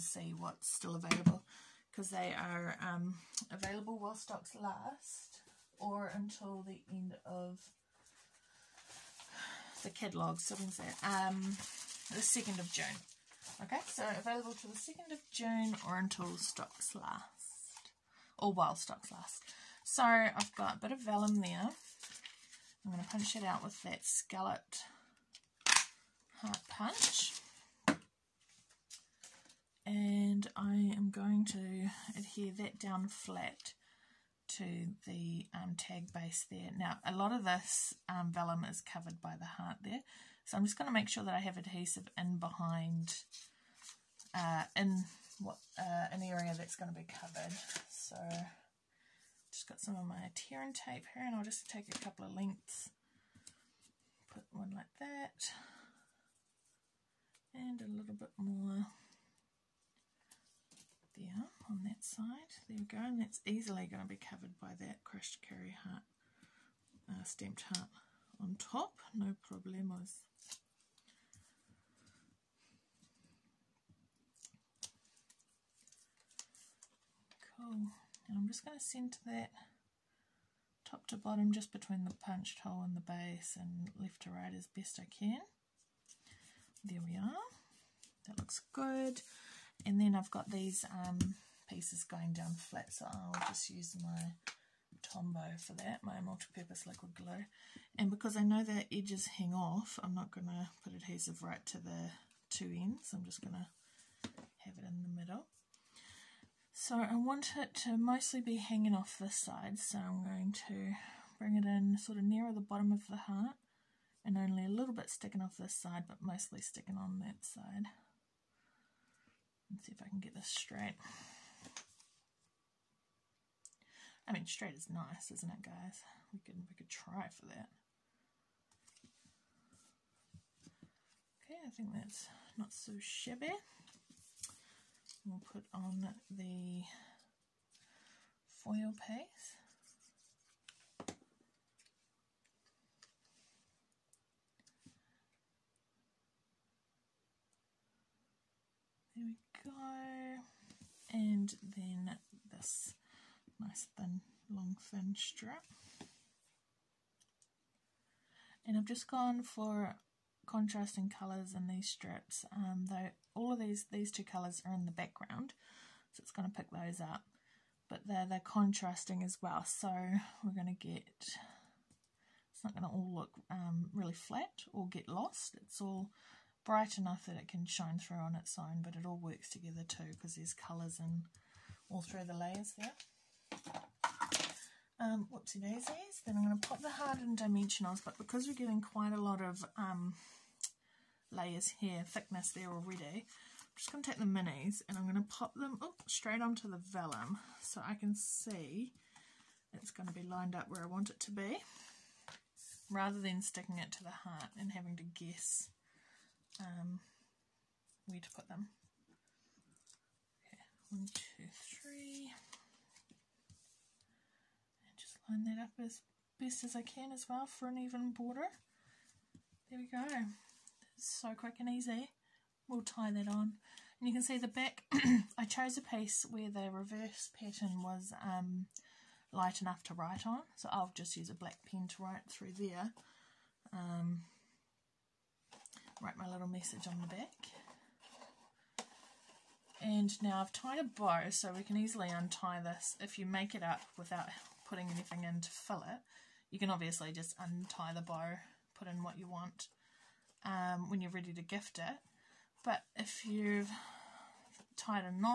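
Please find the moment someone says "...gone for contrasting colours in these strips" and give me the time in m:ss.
2:39.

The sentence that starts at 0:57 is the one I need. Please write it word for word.
And a little bit more that side.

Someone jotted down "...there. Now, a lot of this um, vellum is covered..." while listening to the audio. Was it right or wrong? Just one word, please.
right.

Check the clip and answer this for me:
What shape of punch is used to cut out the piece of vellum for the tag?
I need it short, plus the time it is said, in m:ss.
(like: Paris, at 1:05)
Scalloped heart, at 0:24.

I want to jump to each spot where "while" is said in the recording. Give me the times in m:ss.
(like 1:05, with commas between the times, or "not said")
0:03, 0:18.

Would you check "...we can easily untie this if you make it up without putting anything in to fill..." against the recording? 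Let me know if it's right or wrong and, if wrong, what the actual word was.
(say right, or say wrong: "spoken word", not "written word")
right.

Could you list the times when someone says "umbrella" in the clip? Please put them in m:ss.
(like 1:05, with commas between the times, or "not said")
not said.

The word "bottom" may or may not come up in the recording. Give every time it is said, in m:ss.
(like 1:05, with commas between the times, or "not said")
1:21, 1:52.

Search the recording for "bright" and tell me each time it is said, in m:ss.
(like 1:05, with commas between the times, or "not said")
2:56.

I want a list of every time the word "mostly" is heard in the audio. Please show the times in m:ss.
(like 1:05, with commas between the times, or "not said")
1:47, 1:56.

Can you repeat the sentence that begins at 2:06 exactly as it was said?
We could, we could try for that.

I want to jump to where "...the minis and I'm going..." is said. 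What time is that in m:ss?
3:14.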